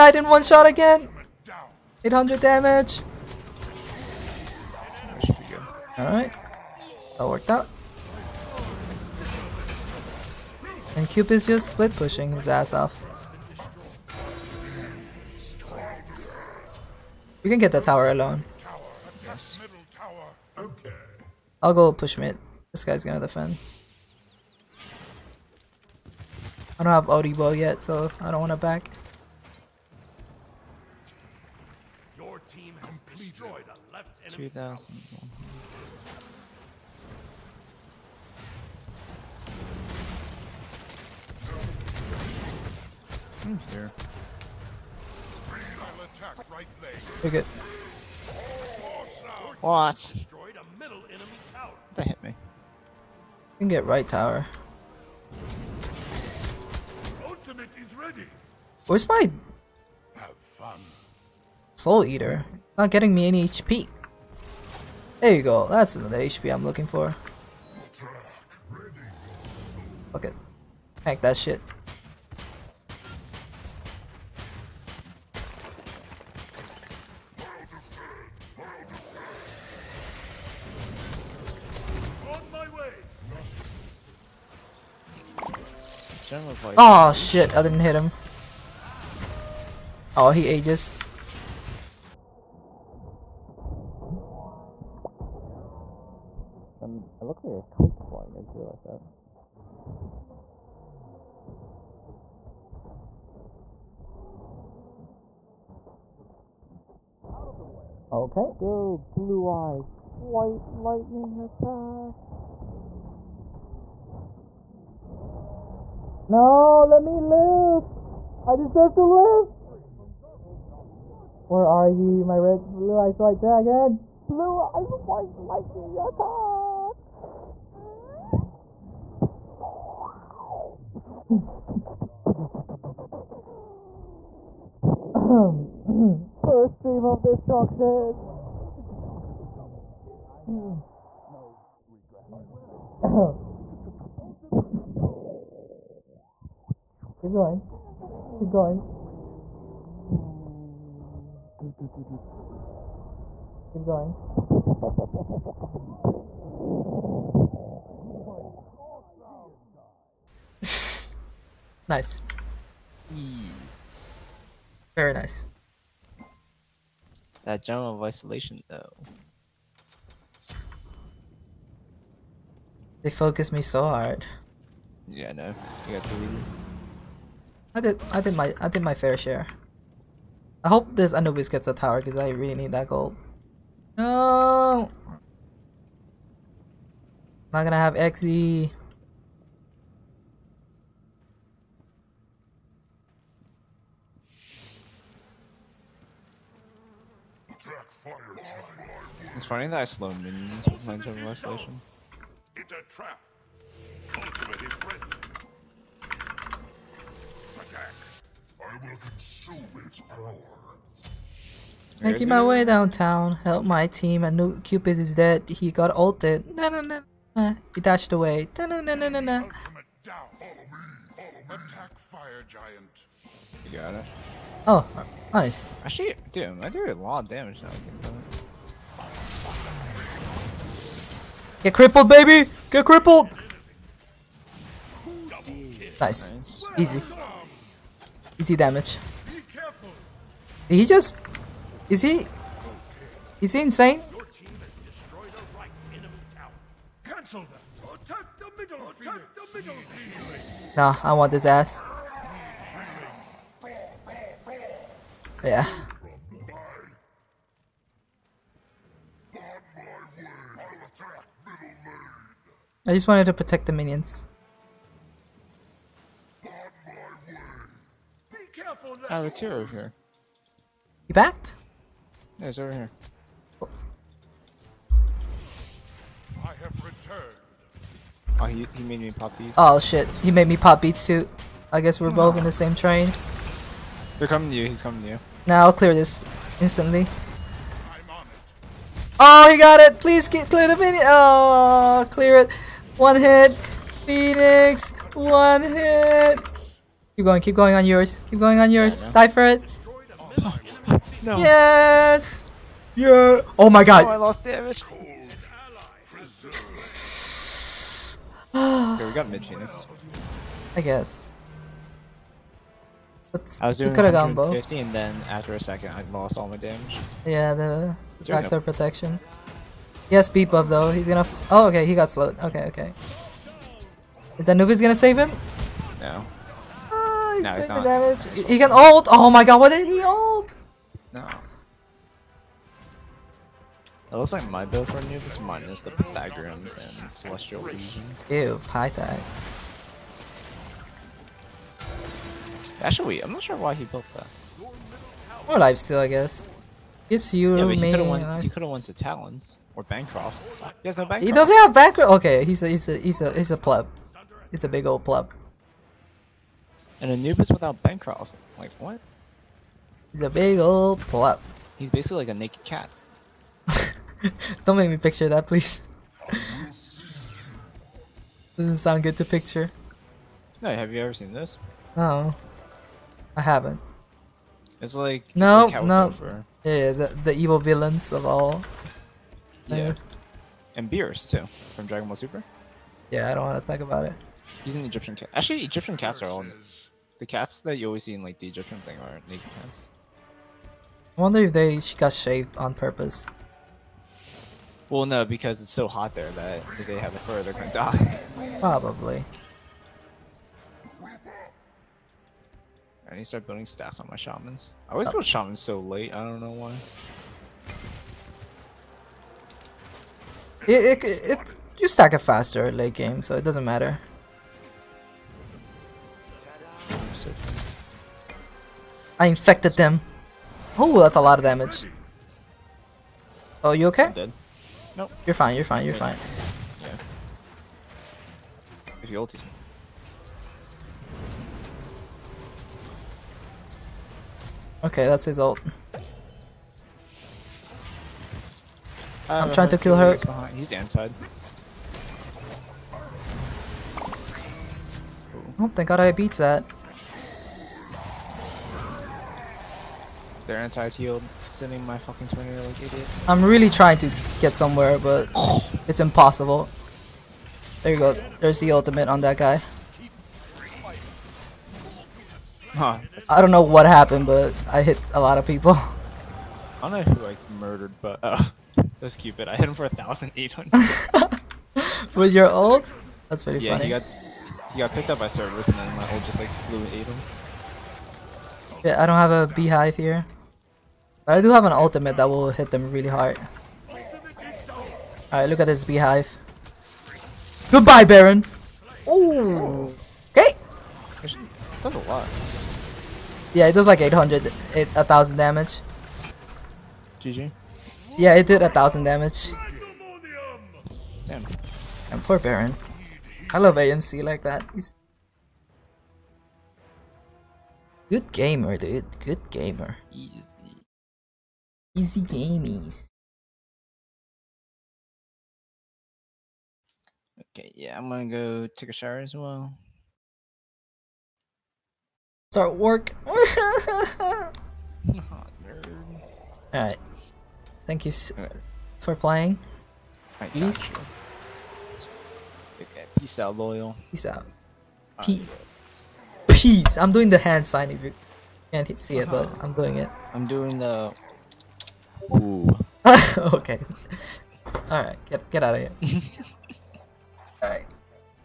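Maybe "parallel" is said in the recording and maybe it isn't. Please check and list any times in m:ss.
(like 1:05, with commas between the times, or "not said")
not said.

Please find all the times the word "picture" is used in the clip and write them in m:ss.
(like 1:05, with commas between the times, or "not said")
6:04, 6:09.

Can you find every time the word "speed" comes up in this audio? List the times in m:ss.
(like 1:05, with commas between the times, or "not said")
5:20.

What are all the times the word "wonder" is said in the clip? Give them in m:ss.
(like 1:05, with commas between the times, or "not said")
6:31.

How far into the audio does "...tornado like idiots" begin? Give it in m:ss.
7:32.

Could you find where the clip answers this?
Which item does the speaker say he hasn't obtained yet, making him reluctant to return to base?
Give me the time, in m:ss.
0:27.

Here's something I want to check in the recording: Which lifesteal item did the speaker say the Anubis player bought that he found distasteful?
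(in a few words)
Pythagoras.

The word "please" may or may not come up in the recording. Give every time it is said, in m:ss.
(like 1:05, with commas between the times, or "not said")
4:50, 6:05.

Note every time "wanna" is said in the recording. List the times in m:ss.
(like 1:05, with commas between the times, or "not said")
0:28.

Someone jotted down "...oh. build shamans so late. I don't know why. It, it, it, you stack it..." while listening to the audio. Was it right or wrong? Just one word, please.
right.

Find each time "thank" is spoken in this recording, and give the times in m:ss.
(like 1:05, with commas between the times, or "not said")
7:25, 8:47.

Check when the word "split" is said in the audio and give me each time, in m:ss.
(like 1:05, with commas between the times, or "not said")
0:11.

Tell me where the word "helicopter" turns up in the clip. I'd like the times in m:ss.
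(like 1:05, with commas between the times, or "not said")
not said.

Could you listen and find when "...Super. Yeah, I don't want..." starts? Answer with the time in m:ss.
6:22.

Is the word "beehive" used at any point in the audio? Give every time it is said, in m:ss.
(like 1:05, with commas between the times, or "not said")
7:59, 8:05.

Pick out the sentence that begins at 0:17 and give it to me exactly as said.
We can get the tower alone.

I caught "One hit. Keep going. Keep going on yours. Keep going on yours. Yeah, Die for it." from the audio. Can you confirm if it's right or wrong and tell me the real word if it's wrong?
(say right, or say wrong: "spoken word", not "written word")
right.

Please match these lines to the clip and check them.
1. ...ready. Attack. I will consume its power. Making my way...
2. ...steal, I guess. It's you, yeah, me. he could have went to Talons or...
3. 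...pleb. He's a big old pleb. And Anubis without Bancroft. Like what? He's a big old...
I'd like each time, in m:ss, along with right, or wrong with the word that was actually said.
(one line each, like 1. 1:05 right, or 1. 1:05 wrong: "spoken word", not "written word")
1. 3:24 right
2. 5:45 right
3. 5:53 right.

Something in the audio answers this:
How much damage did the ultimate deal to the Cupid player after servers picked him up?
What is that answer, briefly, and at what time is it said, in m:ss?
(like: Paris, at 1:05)
1,800, at 7:49.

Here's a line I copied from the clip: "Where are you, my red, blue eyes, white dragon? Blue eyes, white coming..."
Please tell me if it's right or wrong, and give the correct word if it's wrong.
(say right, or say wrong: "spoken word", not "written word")
wrong: "lightning", not "coming".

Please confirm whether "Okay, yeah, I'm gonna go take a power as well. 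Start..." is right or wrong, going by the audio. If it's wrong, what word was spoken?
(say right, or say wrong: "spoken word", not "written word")
wrong: "shower", not "power".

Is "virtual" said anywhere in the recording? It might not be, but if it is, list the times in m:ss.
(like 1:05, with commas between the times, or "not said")
not said.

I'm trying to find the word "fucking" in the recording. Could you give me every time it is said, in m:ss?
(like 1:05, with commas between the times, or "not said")
7:31.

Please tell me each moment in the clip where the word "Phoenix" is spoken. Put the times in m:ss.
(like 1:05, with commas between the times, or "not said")
4:54, 5:09.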